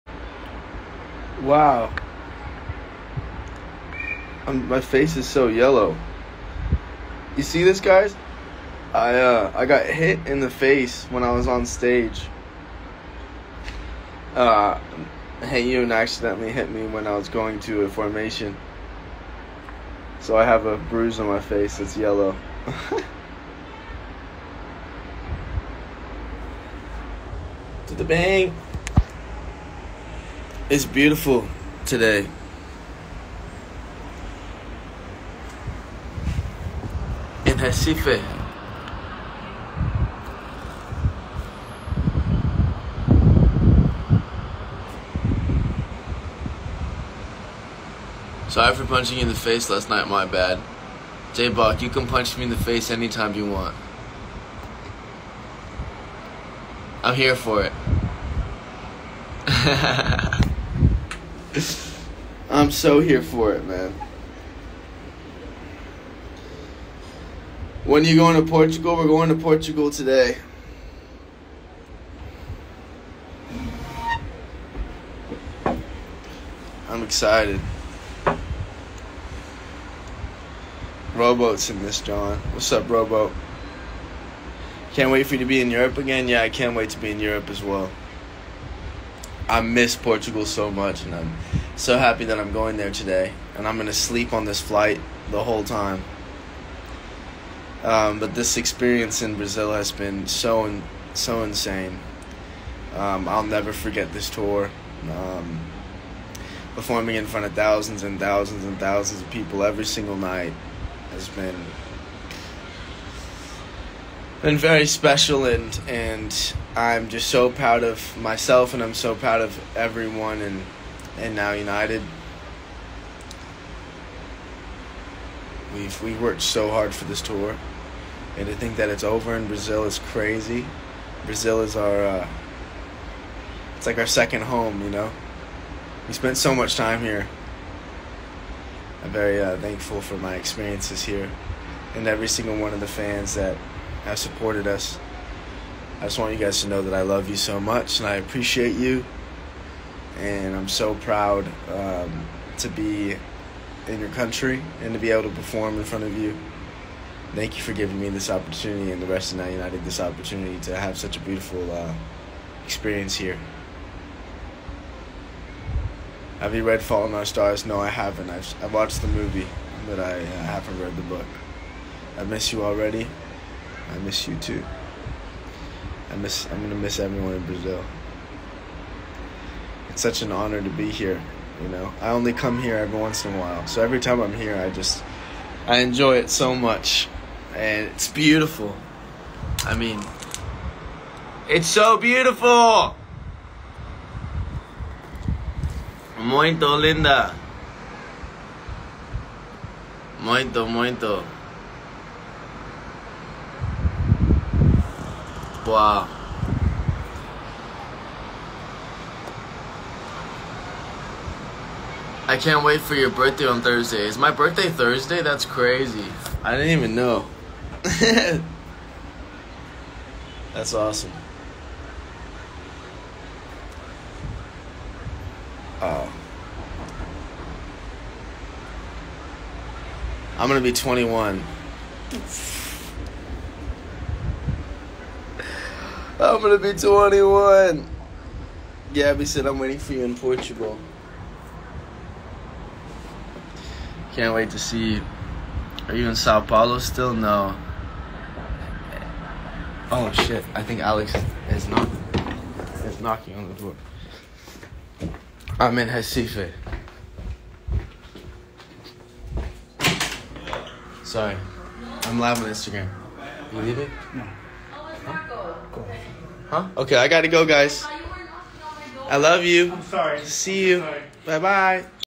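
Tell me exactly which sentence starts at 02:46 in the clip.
Have you read *Fault in Our Stars?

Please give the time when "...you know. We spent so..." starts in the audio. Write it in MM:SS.
02:14.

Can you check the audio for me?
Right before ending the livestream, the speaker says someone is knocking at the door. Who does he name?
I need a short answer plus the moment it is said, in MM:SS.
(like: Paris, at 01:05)
Alex, at 04:10.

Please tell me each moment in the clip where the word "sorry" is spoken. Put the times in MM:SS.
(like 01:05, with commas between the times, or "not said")
00:48, 04:21, 04:29.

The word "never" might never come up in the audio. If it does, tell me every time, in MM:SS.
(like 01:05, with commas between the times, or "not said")
01:43.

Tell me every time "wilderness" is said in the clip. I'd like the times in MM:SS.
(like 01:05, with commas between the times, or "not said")
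not said.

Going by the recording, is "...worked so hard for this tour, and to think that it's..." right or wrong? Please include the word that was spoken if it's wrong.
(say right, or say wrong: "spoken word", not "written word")
right.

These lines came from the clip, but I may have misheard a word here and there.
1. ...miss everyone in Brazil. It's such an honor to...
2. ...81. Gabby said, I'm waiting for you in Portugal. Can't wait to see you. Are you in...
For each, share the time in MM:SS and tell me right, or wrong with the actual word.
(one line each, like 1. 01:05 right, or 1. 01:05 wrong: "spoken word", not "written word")
1. 02:56 right
2. 03:56 wrong: "21", not "81".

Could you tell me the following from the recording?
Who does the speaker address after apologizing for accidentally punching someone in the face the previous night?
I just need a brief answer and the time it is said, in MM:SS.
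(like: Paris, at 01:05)
J Bach, at 00:51.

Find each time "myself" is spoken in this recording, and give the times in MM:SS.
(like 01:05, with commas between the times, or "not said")
01:58.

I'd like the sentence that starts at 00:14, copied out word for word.
Uh, Hey you accidentally hit me when I was going to a formation.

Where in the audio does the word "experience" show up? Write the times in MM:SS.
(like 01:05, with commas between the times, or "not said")
01:38, 02:20, 02:42.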